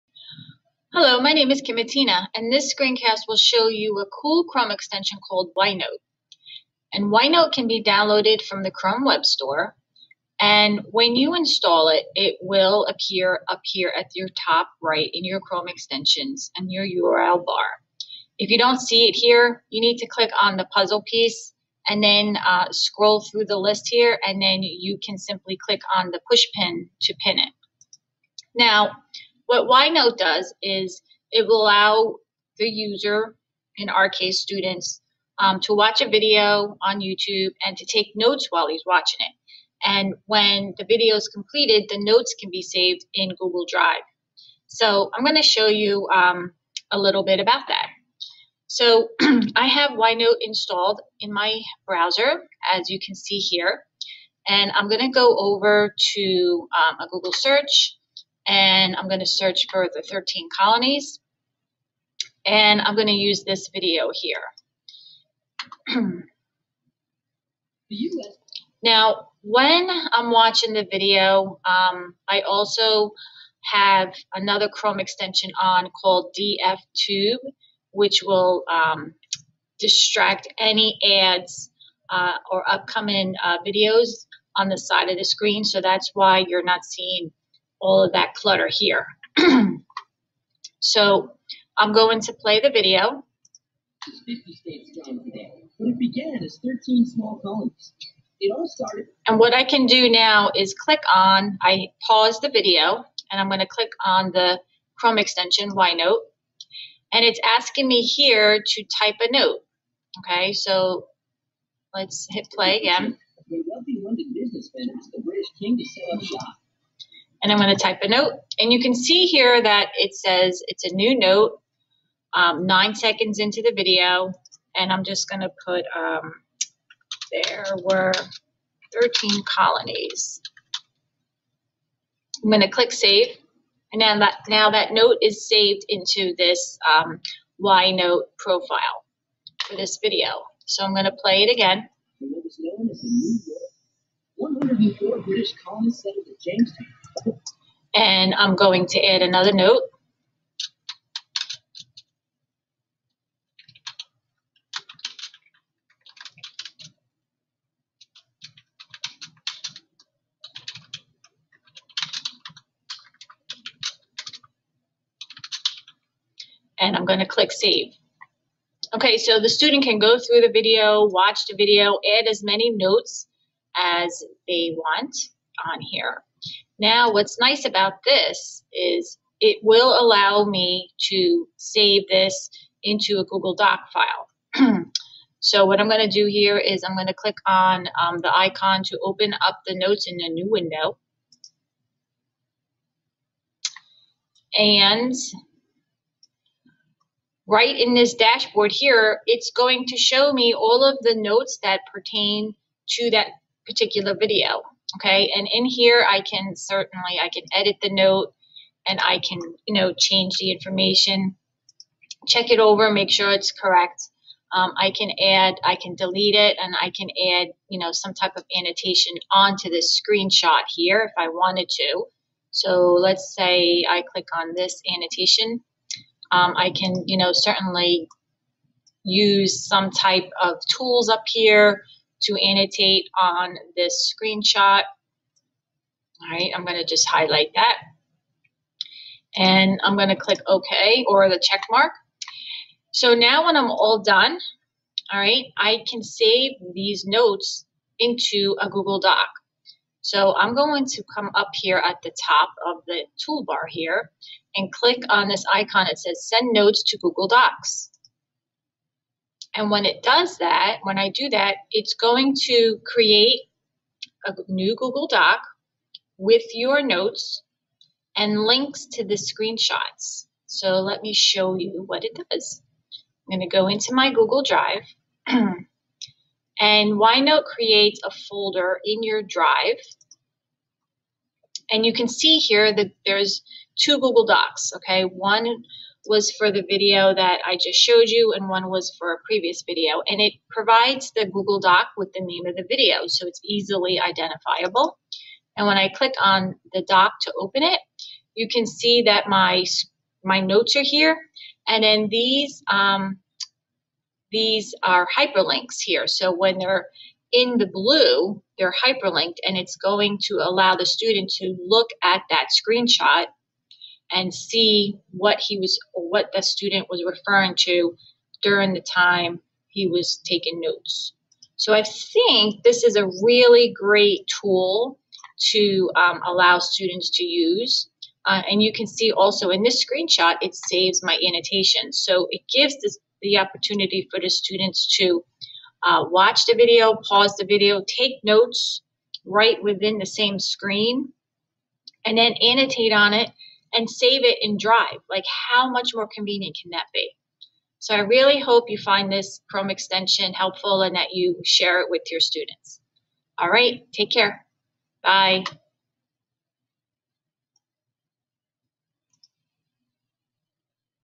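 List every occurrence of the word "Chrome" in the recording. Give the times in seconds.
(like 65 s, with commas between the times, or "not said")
4 s, 8 s, 15 s, 74 s, 104 s, 349 s.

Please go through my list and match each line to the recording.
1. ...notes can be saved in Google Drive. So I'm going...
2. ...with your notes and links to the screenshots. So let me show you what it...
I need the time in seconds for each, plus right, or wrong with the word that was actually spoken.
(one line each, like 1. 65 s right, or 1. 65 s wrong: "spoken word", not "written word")
1. 42 s right
2. 266 s right.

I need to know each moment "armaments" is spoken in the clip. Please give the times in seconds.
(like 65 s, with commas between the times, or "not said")
not said.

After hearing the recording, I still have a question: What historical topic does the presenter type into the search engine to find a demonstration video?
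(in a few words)
the 13 colonies.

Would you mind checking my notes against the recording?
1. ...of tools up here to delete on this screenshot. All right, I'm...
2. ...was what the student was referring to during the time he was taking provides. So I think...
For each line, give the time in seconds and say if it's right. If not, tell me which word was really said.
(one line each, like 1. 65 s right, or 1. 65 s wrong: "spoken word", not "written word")
1. 230 s wrong: "annotate", not "delete"
2. 315 s wrong: "notes", not "provides".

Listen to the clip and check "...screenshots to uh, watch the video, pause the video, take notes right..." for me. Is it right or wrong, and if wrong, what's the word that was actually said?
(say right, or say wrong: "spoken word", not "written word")
wrong: "students", not "screenshots".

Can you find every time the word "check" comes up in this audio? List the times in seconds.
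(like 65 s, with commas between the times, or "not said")
212 s, 241 s.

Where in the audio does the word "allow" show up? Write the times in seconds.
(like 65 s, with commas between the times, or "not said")
31 s, 180 s, 310 s, 326 s.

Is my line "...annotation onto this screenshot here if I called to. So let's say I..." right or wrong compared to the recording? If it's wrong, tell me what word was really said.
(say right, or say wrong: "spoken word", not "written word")
wrong: "wanted", not "called".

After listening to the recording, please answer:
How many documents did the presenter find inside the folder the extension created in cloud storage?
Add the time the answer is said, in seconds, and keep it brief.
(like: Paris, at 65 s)
2, at 283 s.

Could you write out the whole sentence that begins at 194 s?
And right in this dashboard here, it's going to show me all of the notes that pertain to that particular video.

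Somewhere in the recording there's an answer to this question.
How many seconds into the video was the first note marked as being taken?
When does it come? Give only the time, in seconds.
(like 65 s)
122 s.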